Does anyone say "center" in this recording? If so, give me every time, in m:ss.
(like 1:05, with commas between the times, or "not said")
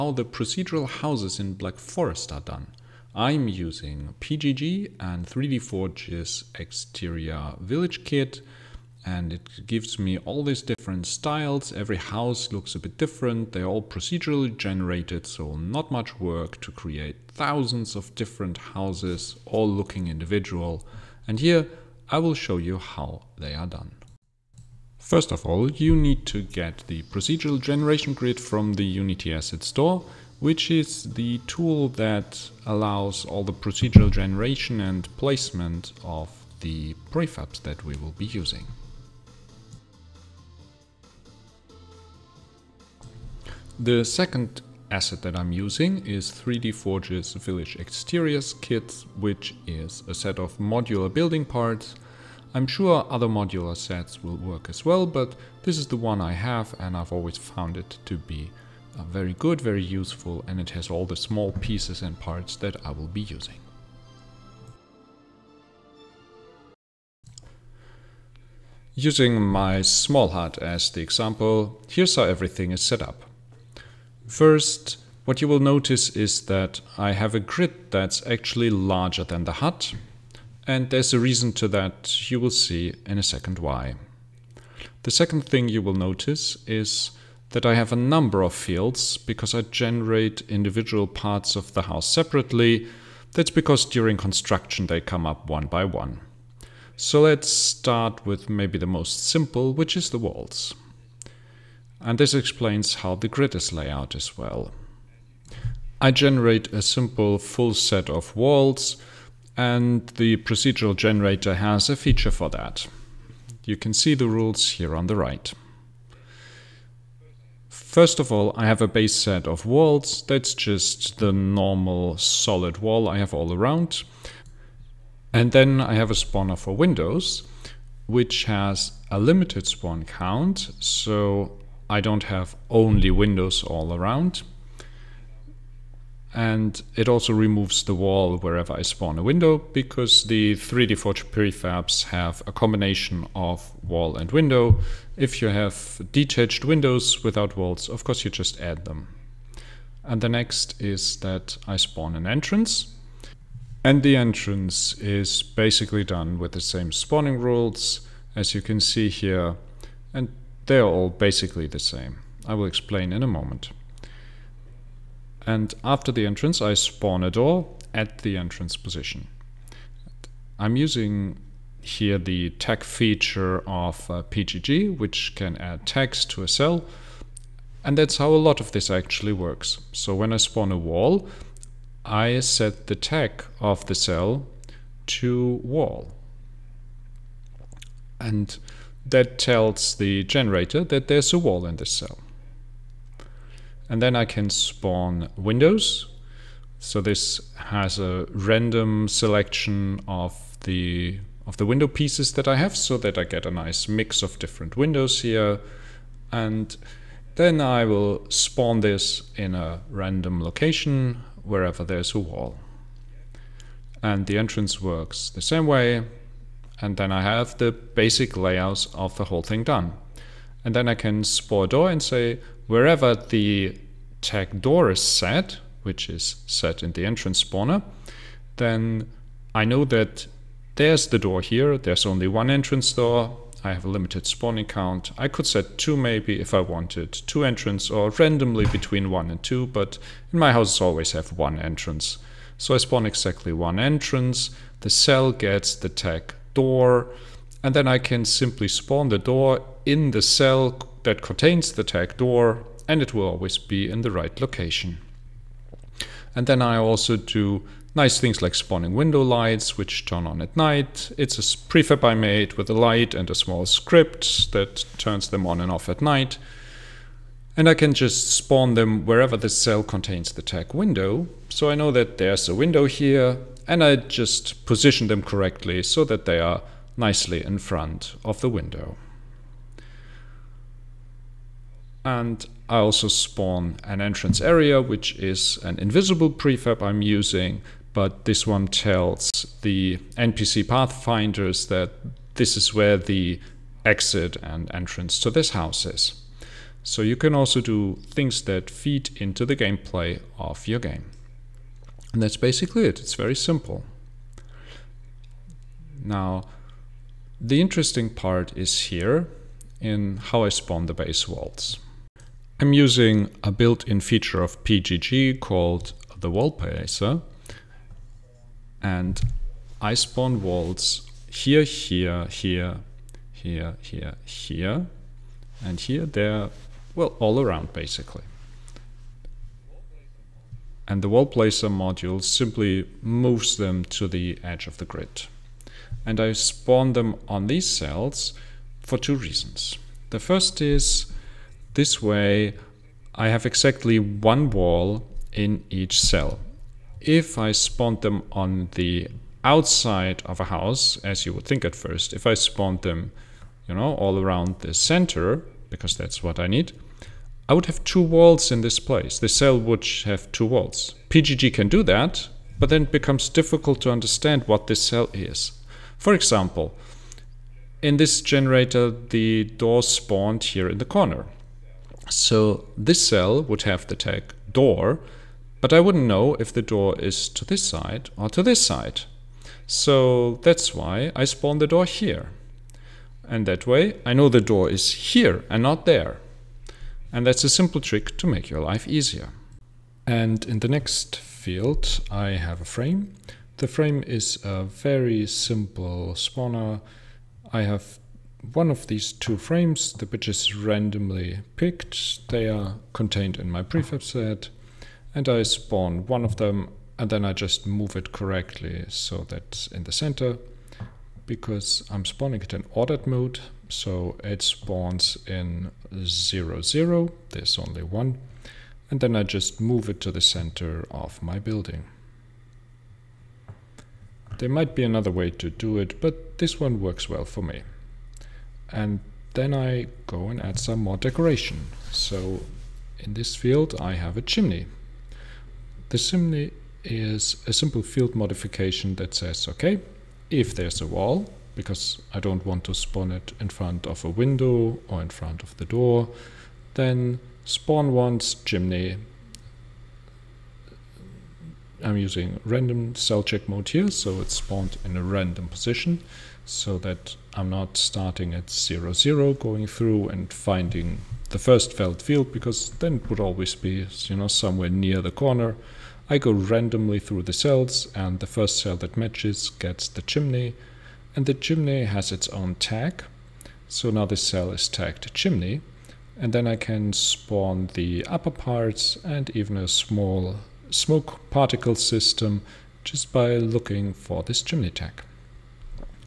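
5:54, 6:49, 7:00.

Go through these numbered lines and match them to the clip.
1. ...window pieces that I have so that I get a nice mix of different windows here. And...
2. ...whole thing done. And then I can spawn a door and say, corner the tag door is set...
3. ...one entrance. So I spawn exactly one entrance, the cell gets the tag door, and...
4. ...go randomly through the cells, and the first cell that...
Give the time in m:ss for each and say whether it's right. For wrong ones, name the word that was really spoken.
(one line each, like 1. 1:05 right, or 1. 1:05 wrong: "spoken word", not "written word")
1. 3:21 right
2. 3:39 wrong: "wherever", not "corner"
3. 4:01 right
4. 7:46 right.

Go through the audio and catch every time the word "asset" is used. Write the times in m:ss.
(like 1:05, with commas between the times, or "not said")
0:29, 0:44.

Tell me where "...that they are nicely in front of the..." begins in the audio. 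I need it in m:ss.
4:36.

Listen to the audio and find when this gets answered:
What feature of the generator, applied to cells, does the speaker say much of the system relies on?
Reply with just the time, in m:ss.
2:52.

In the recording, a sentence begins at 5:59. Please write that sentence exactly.
The cell would have two walls.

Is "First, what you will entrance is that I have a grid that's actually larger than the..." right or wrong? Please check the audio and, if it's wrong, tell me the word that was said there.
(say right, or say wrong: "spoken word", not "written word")
wrong: "notice", not "entrance".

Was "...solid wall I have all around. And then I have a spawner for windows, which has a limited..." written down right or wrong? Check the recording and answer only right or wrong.
right.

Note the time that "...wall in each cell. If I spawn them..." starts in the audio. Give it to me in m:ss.
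5:44.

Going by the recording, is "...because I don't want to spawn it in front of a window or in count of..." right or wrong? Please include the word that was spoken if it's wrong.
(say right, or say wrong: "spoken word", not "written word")
wrong: "front", not "count".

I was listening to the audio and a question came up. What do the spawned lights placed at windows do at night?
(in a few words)
turn on.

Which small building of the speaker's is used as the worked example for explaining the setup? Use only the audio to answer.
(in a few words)
small hut.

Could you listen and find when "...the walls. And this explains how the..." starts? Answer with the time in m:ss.
1:40.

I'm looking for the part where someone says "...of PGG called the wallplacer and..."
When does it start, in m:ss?
5:14.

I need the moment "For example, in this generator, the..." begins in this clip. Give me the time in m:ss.
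6:05.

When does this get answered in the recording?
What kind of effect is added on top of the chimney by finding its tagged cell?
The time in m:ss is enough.
8:00.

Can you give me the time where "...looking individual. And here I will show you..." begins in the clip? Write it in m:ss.
0:19.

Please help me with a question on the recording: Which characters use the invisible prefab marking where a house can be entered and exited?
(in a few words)
NPC pathfinders.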